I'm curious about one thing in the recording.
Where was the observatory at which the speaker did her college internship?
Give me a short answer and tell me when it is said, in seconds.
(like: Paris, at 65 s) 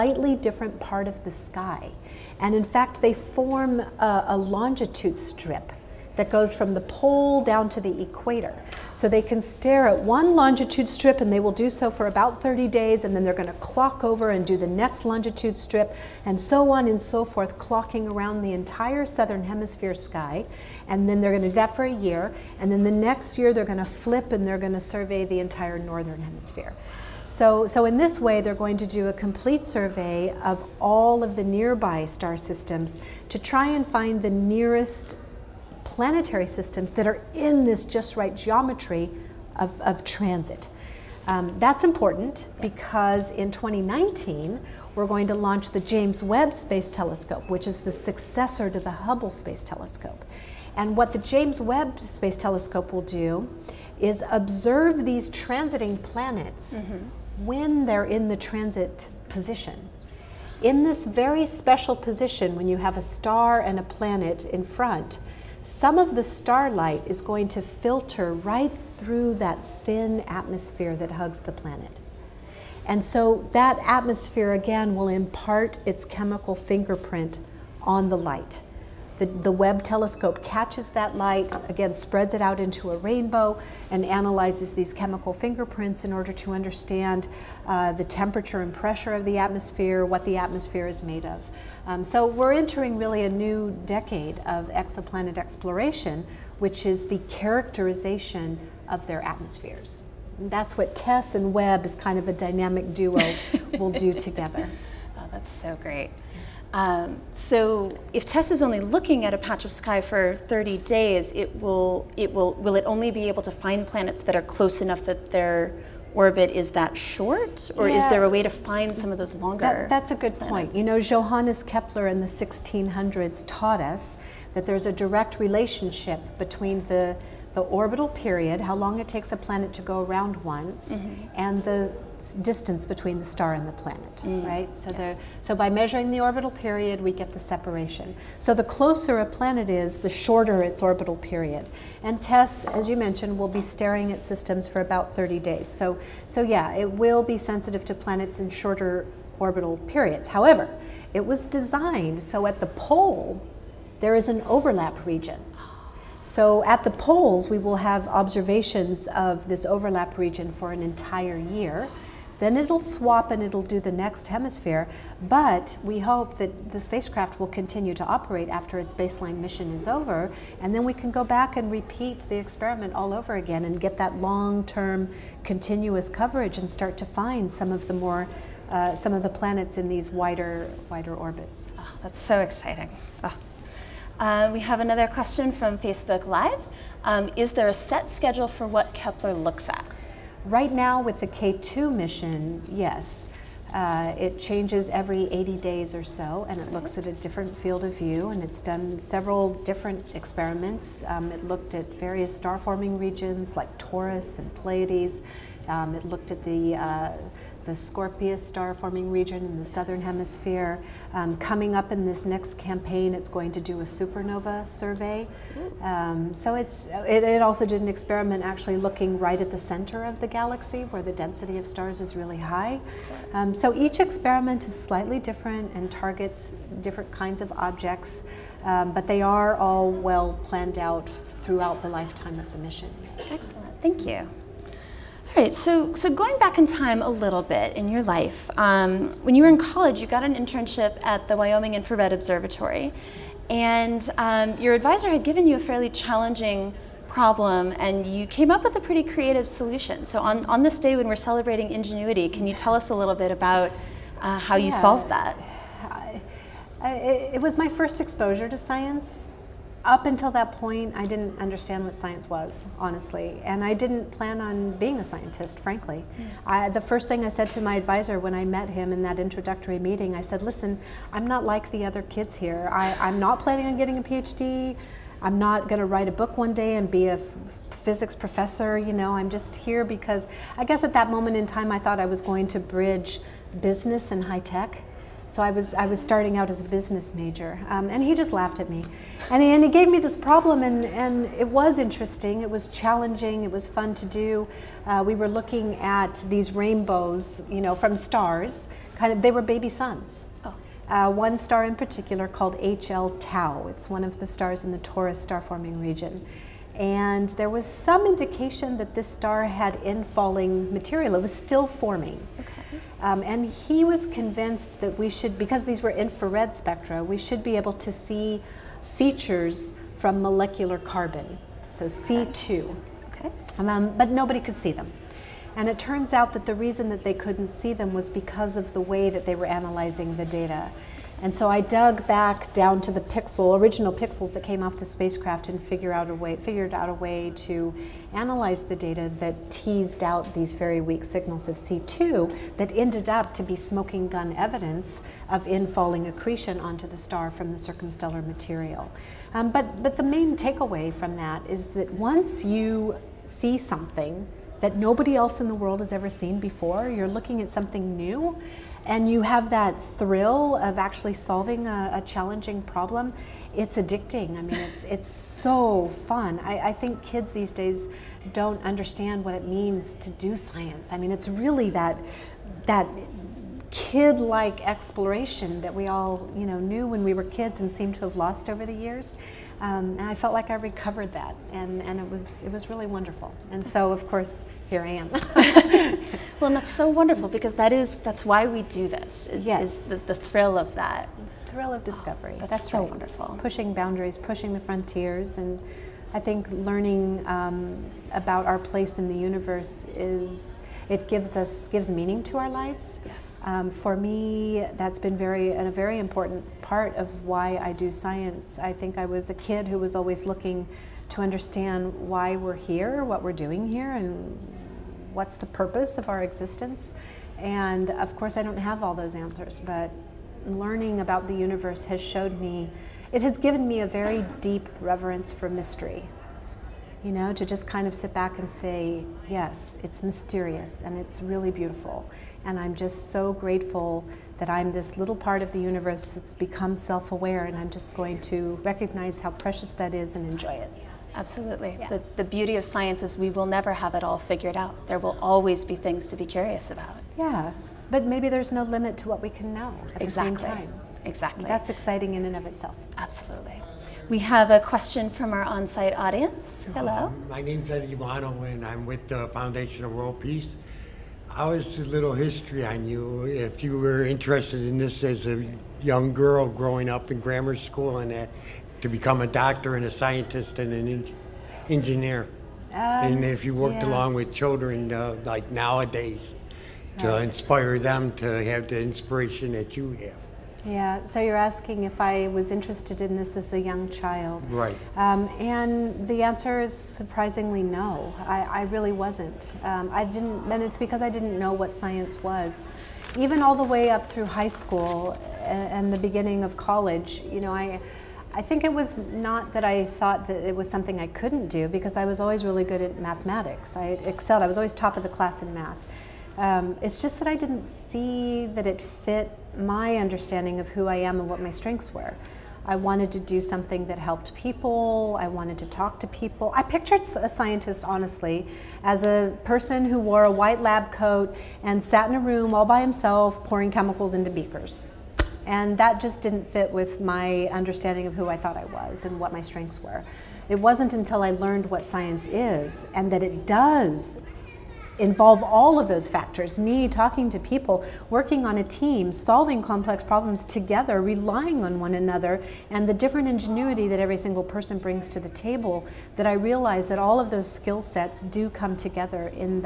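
Wyoming, at 241 s.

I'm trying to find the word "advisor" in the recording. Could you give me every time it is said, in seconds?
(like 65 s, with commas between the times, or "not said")
244 s, 267 s.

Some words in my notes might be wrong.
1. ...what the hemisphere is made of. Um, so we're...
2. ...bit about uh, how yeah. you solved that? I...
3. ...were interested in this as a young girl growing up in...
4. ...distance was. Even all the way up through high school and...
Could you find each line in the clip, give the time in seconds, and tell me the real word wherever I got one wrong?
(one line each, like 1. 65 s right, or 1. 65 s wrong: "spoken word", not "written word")
1. 90 s wrong: "atmosphere", not "hemisphere"
2. 253 s right
3. 463 s right
4. 491 s wrong: "science", not "distance".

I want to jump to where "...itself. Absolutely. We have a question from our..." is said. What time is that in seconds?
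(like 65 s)
452 s.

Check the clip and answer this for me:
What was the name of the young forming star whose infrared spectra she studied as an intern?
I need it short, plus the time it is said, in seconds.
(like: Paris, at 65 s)
HL Tau, at 302 s.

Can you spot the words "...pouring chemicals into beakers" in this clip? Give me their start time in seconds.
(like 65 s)
523 s.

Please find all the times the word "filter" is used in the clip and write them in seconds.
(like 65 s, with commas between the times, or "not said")
67 s.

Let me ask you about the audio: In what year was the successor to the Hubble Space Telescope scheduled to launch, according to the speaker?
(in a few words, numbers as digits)
2019.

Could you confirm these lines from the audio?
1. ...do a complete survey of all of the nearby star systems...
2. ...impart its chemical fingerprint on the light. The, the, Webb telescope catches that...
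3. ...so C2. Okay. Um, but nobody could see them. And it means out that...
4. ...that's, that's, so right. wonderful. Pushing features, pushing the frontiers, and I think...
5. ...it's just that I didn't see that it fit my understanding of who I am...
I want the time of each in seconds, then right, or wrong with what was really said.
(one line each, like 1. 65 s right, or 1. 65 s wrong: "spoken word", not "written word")
1. 28 s right
2. 75 s right
3. 321 s wrong: "turns", not "means"
4. 392 s wrong: "boundaries", not "features"
5. 506 s right.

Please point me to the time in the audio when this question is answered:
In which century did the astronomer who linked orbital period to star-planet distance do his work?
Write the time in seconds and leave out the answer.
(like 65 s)
122 s.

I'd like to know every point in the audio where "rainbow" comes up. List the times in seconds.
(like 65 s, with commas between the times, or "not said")
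82 s, 296 s.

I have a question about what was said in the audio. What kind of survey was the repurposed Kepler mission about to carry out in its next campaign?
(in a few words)
Supernova survey.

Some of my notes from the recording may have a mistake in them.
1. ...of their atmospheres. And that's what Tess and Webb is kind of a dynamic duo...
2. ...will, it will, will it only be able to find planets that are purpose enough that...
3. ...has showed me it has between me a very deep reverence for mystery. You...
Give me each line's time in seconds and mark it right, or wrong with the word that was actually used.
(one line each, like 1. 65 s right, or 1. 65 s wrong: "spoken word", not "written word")
1. 98 s right
2. 111 s wrong: "close", not "purpose"
3. 421 s wrong: "given", not "between".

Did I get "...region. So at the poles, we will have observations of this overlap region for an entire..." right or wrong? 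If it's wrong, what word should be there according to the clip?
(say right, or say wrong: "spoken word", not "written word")
right.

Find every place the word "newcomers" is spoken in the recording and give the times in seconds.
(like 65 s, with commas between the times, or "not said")
not said.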